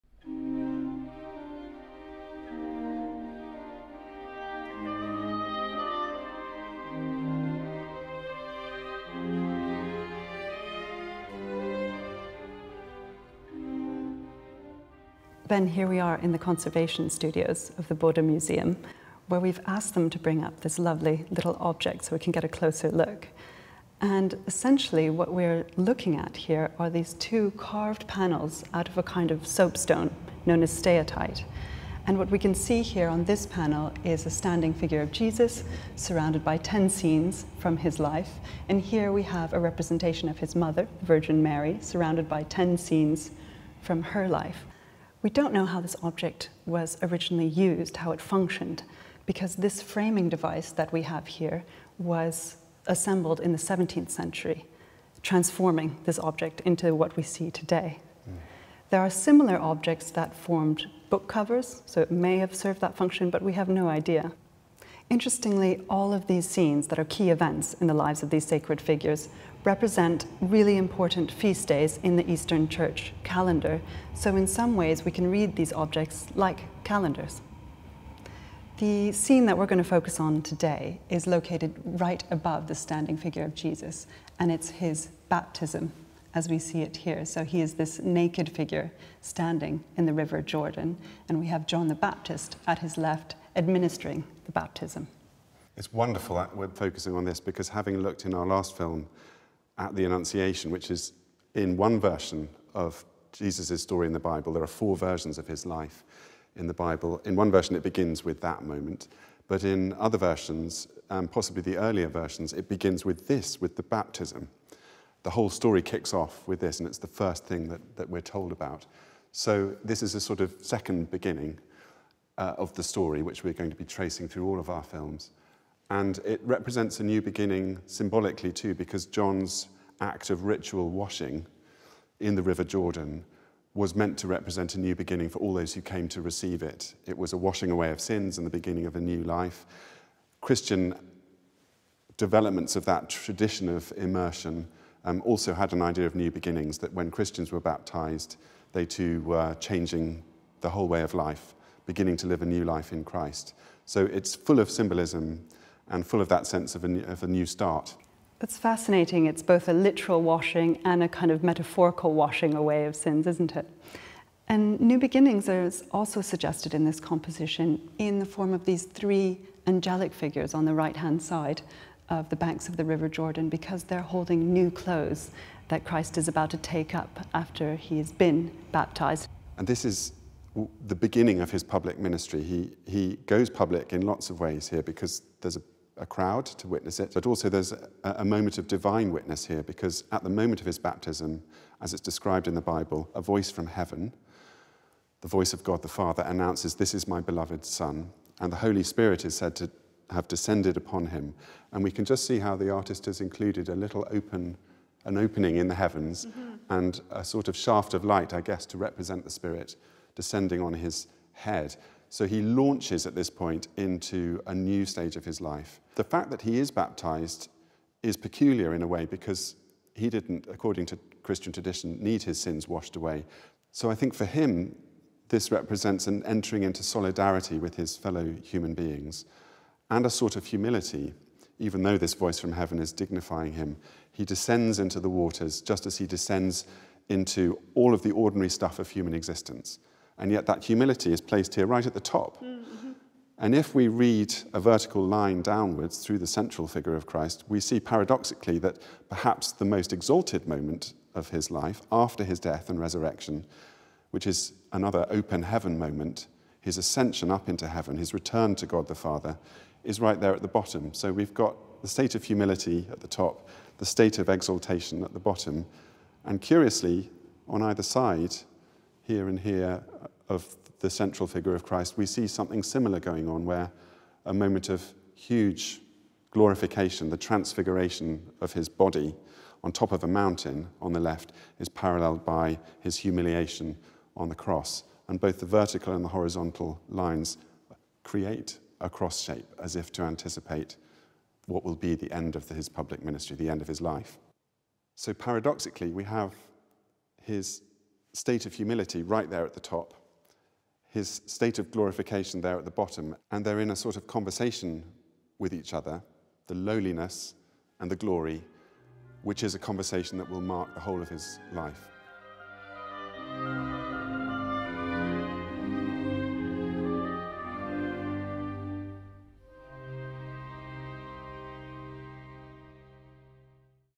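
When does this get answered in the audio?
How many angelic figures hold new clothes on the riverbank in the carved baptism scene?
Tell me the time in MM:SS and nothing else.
02:48.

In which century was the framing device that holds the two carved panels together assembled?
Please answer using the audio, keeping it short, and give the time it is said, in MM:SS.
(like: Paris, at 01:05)
17th century, at 00:53.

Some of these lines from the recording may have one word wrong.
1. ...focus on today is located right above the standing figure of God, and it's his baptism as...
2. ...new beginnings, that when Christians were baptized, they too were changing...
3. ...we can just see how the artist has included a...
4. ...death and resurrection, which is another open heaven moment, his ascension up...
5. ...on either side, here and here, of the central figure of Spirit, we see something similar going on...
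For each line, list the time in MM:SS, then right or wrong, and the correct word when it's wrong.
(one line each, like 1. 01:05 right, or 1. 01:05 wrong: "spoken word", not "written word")
1. 01:19 wrong: "Jesus", not "God"
2. 02:26 right
3. 03:21 right
4. 04:12 right
5. 04:27 wrong: "Christ", not "Spirit".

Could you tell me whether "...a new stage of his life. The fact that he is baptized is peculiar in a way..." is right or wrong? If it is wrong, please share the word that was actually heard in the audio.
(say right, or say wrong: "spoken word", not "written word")
right.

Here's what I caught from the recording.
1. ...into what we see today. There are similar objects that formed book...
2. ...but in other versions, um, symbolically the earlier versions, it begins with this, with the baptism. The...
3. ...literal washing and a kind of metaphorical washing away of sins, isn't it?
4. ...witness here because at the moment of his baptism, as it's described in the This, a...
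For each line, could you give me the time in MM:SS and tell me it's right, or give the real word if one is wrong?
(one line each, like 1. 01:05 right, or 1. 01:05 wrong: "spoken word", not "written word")
1. 00:56 right
2. 01:49 wrong: "possibly", not "symbolically"
3. 02:39 right
4. 03:09 wrong: "Bible", not "This".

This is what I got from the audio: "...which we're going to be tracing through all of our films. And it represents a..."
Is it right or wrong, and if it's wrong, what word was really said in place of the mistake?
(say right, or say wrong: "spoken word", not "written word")
right.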